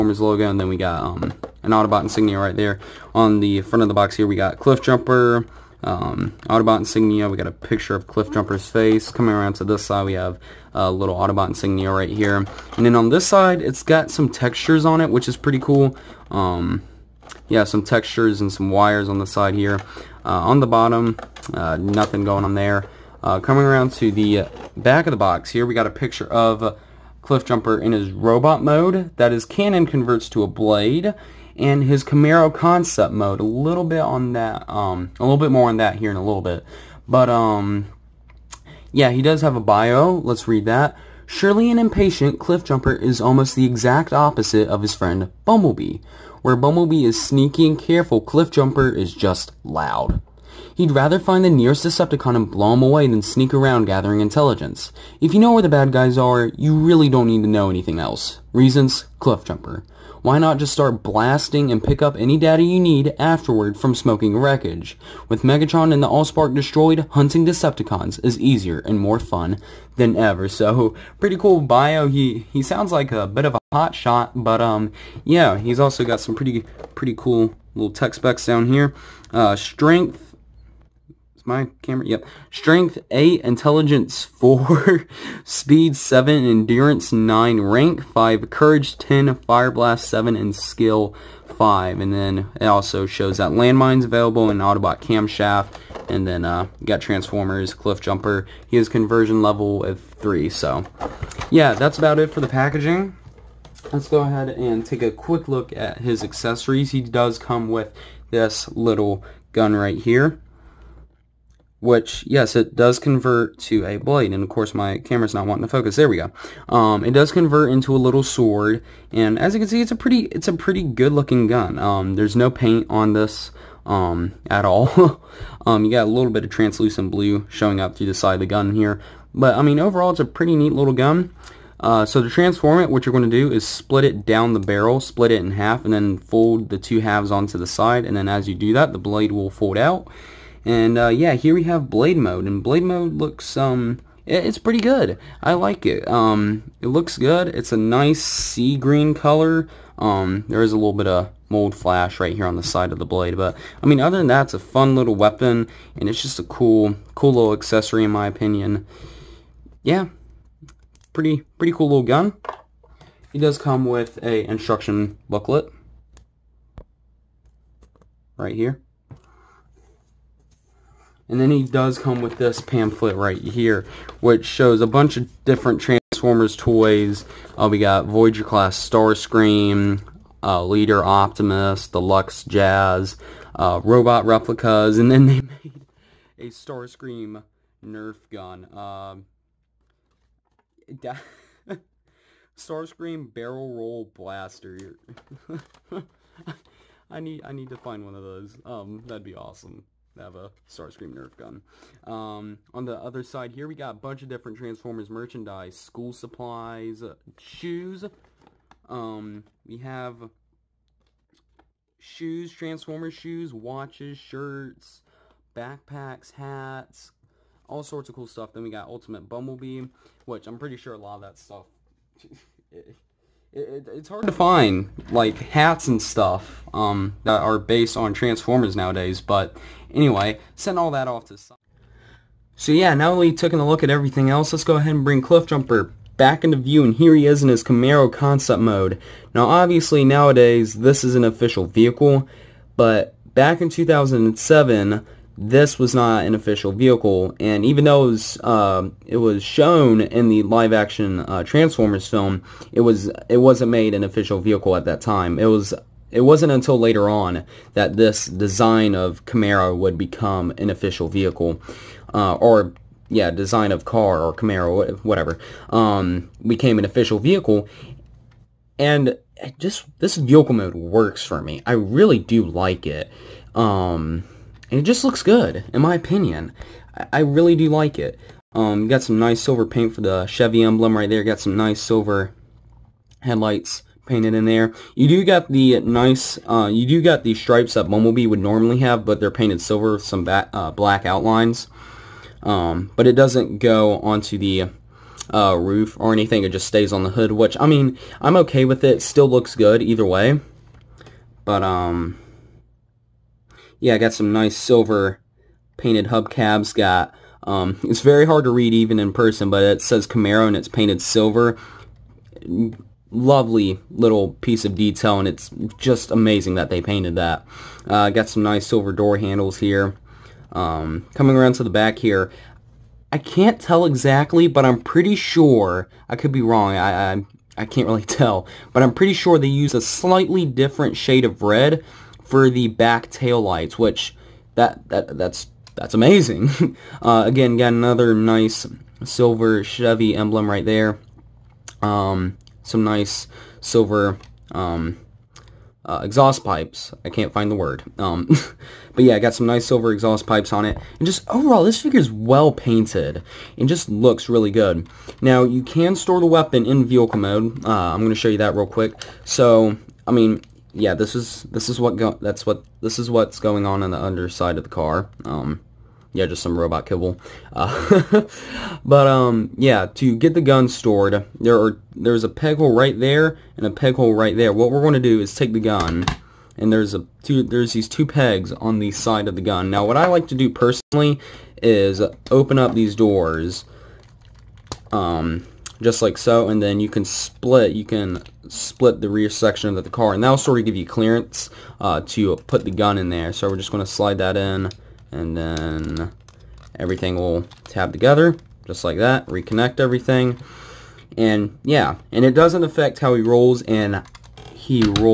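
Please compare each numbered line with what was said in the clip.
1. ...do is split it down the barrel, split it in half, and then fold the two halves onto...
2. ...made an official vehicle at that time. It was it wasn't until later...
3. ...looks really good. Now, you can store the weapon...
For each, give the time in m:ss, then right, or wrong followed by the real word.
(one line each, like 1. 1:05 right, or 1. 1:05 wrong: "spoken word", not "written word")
1. 2:13 right
2. 4:13 right
3. 5:53 right.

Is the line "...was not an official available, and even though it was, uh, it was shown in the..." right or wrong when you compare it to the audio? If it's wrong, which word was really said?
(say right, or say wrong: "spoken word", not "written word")
wrong: "vehicle", not "available".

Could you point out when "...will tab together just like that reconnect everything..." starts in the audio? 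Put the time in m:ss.
6:37.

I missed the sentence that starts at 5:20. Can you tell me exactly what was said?
Um, coming around to the back here, I can't tell exactly, but I'm pretty sure.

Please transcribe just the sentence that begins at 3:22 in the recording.
Um, on the other side here, we got a bunch of different Transformers merchandise, school supplies, uh, shoes.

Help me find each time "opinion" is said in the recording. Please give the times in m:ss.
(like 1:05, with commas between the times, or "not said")
2:38, 4:35.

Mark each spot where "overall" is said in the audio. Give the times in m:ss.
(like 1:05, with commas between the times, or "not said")
2:09, 5:51.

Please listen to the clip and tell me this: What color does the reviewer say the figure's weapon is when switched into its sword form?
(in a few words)
Sea green.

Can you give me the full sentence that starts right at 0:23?
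Uh, coming around to the back of the box here, we got a picture of Cliff Jumper in his robot mode.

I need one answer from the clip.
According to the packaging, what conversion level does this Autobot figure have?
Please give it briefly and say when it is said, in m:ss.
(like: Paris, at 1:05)
3, at 1:38.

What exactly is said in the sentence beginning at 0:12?
And then on this side, it's got some textures on it, which is pretty cool.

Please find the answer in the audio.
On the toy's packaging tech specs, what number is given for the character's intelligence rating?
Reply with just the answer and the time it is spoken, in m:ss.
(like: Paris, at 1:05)
4, at 1:23.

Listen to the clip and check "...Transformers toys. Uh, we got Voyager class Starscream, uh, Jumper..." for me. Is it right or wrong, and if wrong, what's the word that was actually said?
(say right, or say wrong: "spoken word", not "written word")
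wrong: "Leader", not "Jumper".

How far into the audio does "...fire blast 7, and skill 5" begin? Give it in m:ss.
1:29.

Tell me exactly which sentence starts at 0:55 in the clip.
If you know where the bad guys are, you really don't need to know anything else.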